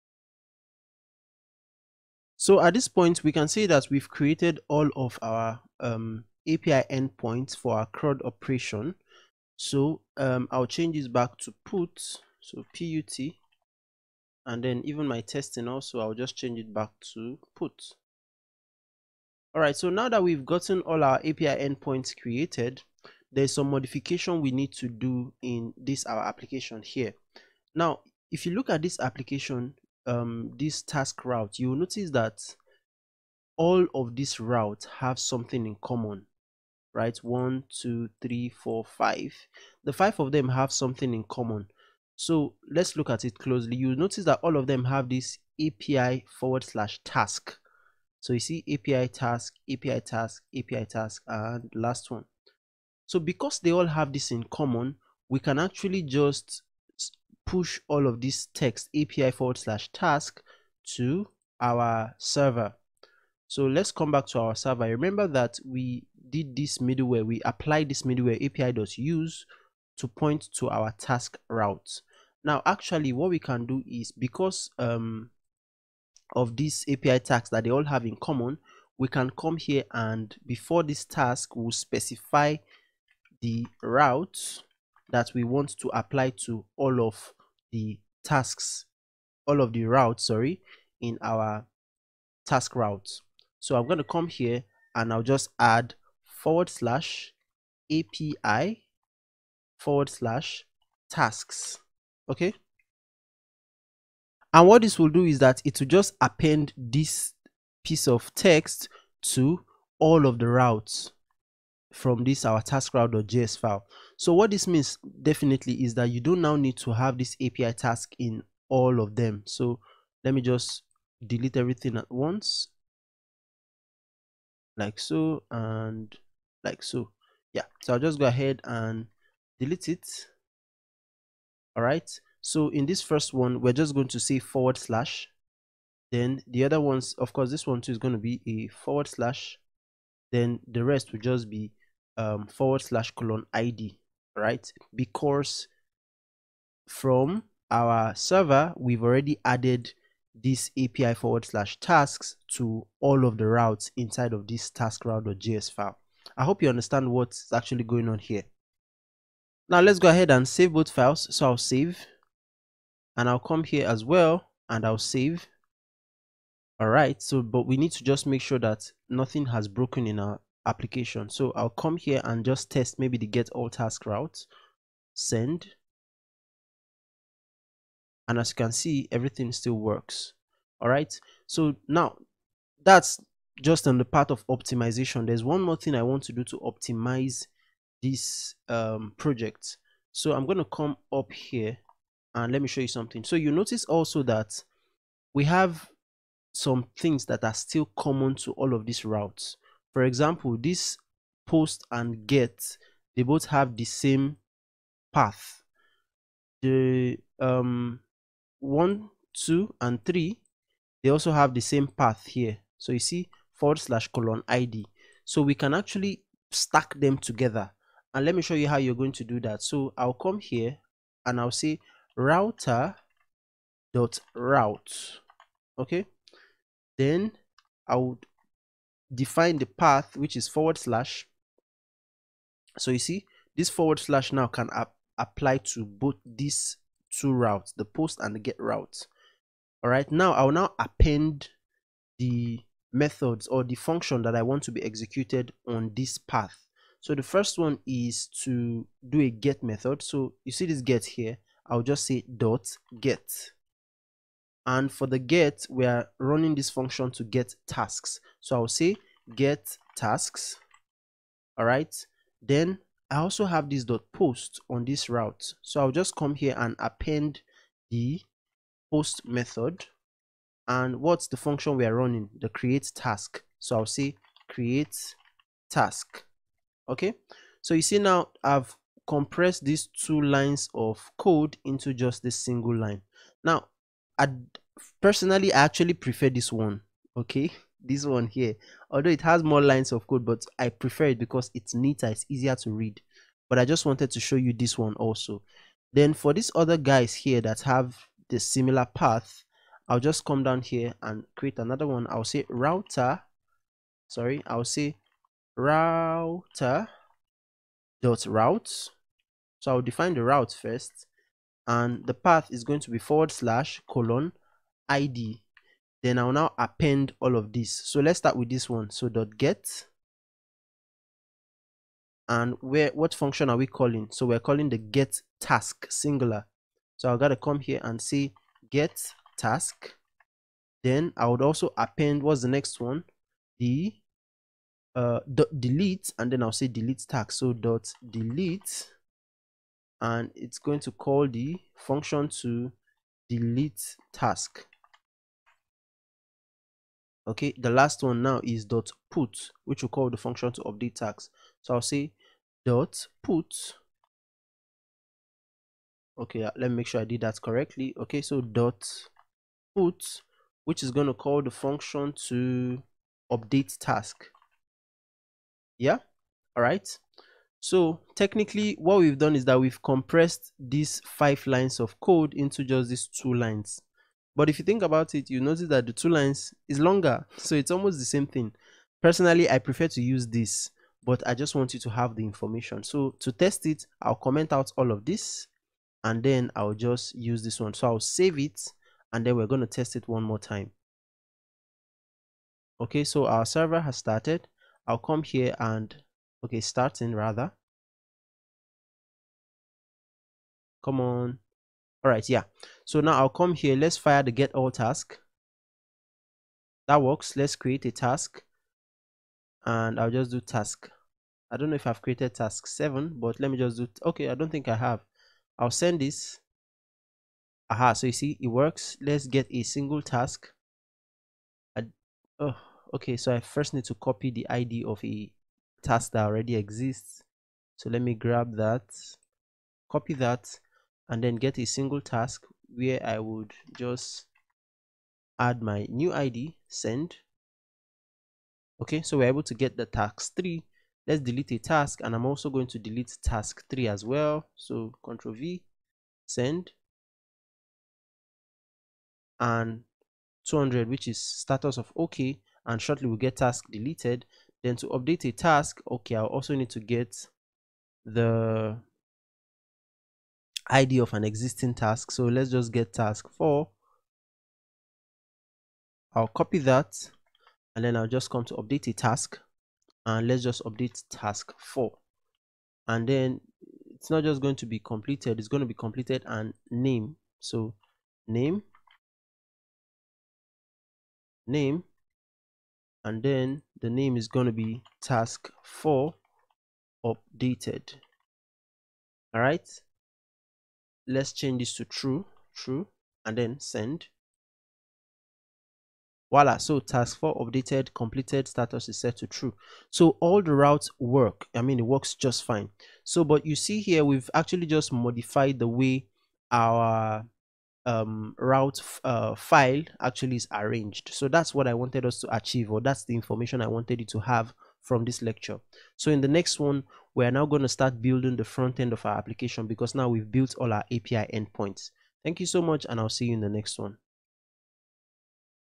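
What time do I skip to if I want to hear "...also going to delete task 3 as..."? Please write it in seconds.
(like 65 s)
442 s.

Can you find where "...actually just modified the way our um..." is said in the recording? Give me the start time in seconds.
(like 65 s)
504 s.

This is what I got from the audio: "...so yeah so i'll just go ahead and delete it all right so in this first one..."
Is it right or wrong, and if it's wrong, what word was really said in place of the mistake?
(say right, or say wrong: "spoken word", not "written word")
right.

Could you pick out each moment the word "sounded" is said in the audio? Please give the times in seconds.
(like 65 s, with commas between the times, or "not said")
not said.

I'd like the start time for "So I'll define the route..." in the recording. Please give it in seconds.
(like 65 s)
309 s.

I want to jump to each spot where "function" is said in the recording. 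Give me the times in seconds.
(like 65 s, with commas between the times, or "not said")
243 s, 256 s, 271 s, 323 s, 341 s, 350 s, 361 s.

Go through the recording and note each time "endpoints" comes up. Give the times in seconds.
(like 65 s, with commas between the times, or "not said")
6 s, 21 s, 521 s.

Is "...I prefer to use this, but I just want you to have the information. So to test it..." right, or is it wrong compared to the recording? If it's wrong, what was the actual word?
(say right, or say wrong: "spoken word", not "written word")
right.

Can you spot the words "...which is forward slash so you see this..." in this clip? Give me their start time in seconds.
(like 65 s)
230 s.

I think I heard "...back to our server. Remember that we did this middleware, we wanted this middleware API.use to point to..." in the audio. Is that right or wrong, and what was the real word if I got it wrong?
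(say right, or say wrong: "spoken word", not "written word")
wrong: "applied", not "wanted".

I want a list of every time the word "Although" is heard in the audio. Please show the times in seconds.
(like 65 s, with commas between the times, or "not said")
288 s.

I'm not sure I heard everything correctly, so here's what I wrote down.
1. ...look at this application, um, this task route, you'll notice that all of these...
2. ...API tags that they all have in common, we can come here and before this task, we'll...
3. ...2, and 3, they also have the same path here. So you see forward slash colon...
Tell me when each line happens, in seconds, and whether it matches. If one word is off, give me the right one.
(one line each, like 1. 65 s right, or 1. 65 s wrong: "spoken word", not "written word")
1. 28 s right
2. 76 s right
3. 209 s right.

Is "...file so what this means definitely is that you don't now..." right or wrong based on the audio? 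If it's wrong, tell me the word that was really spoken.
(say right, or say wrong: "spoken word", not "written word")
right.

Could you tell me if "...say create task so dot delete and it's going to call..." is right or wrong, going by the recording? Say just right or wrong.
wrong.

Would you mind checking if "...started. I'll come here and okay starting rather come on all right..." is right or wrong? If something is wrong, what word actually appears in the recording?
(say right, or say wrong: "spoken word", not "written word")
right.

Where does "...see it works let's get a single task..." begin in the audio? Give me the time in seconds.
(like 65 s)
418 s.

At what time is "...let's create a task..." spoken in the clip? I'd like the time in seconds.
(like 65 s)
407 s.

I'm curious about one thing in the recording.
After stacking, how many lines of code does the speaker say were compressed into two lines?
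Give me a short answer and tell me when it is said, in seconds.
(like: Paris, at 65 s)
5, at 371 s.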